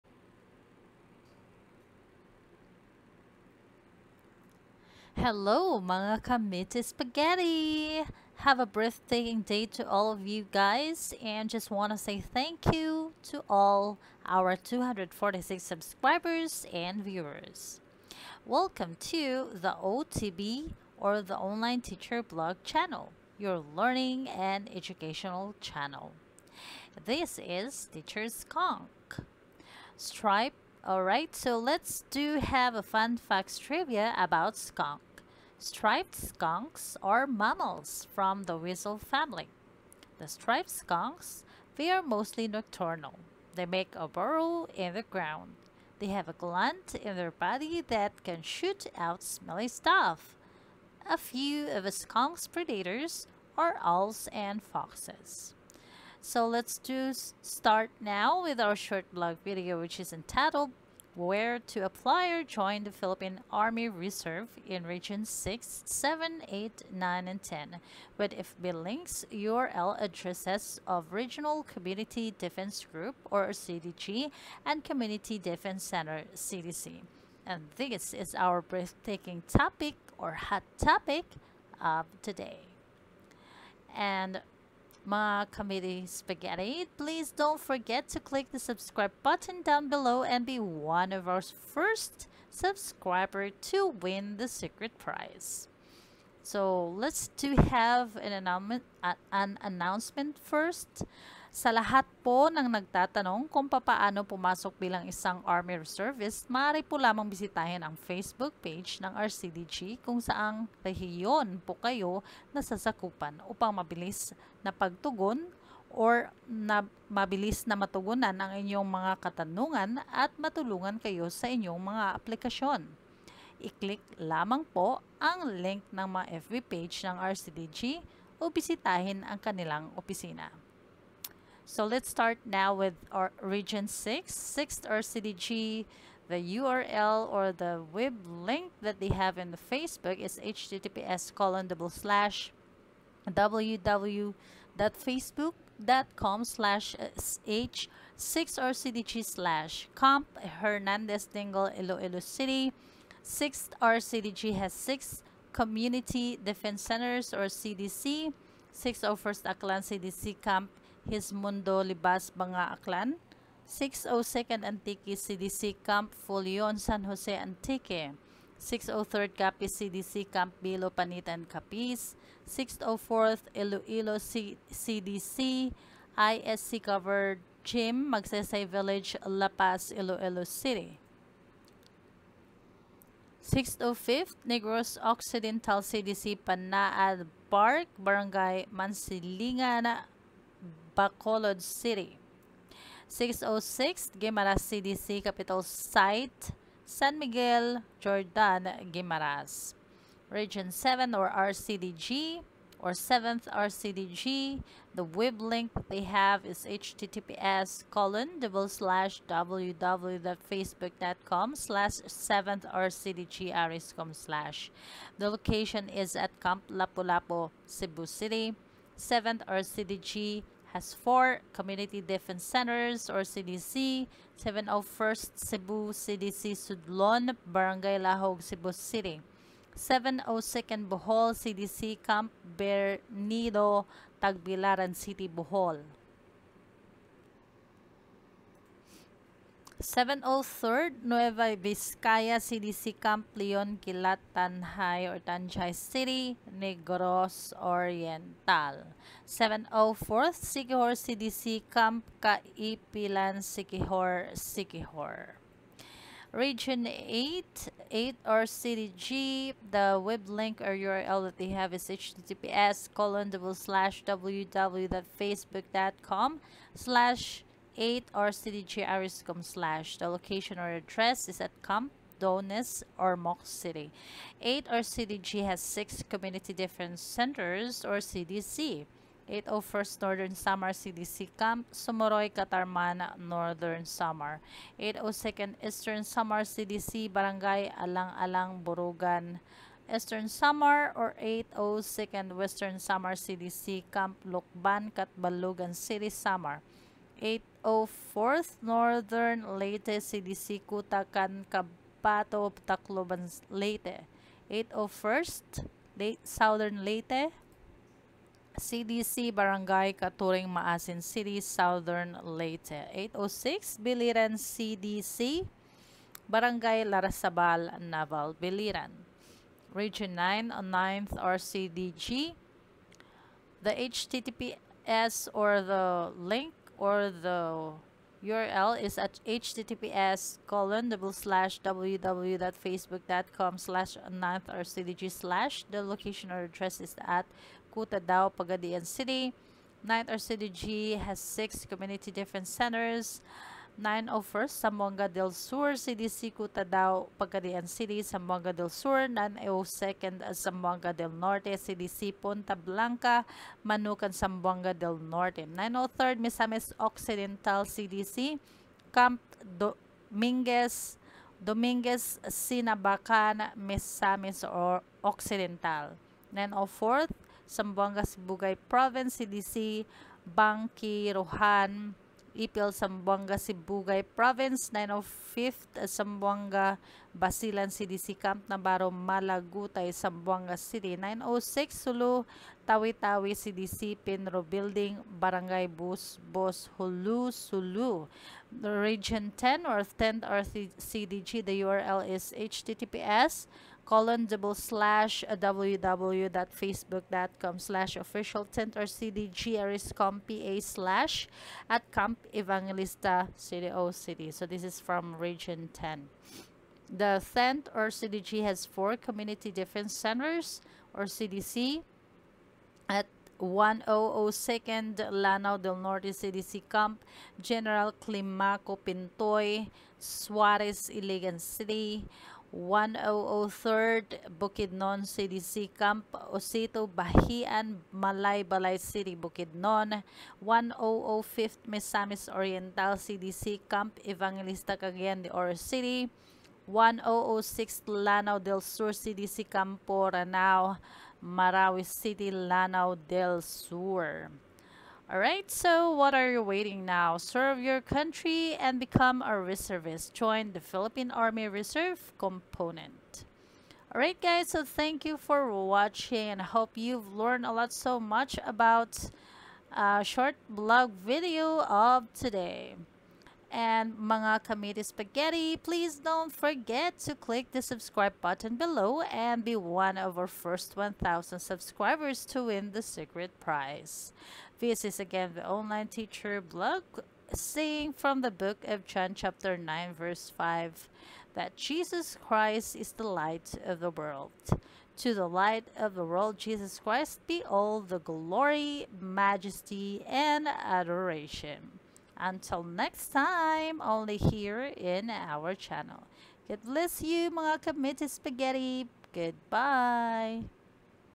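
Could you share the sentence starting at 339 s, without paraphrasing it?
Ninth RCDG has six community different centers.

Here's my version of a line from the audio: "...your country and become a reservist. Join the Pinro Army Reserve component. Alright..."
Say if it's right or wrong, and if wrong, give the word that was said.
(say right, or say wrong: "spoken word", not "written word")
wrong: "Philippine", not "Pinro".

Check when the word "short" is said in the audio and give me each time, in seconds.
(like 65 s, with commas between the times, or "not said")
58 s, 460 s.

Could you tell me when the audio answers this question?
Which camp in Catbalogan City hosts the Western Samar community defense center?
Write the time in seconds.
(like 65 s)
293 s.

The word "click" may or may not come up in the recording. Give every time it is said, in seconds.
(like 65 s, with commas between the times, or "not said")
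88 s, 123 s, 467 s.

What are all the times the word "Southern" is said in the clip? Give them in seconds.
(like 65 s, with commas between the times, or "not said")
306 s, 311 s.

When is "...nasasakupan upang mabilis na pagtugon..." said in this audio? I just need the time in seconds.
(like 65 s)
112 s.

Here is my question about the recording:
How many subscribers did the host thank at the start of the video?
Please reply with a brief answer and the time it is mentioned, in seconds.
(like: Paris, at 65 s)
246, at 14 s.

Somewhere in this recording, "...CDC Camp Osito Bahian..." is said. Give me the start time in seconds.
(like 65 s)
425 s.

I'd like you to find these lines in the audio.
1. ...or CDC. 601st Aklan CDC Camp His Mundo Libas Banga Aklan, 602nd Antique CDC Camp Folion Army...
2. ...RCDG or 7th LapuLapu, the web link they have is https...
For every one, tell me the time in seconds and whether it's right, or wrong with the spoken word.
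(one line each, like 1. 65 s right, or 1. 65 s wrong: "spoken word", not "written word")
1. 157 s wrong: "San", not "Army"
2. 201 s wrong: "RCDG", not "LapuLapu".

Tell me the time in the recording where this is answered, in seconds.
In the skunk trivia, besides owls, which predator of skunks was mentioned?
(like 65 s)
54 s.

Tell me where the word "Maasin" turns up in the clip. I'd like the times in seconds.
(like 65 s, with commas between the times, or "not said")
310 s.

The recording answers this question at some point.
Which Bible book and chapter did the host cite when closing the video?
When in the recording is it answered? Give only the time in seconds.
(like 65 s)
478 s.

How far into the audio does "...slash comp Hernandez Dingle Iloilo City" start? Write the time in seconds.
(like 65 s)
149 s.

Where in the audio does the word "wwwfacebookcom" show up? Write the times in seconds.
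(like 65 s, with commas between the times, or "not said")
143 s, 209 s, 264 s, 331 s, 395 s.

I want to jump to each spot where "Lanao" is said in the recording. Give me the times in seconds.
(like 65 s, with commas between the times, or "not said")
415 s, 437 s, 442 s.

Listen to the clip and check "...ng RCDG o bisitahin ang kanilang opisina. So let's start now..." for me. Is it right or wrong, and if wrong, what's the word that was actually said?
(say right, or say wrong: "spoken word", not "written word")
right.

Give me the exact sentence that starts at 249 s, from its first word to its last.
704th Siquijor CDC Camp Kaipilan Siquijor Siquijor.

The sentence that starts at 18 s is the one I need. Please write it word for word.
Welcome to the OTV or the Online Teacher Vlog channel, your learning and educational channel.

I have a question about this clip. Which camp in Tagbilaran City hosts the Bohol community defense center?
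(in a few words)
Camp Bernido.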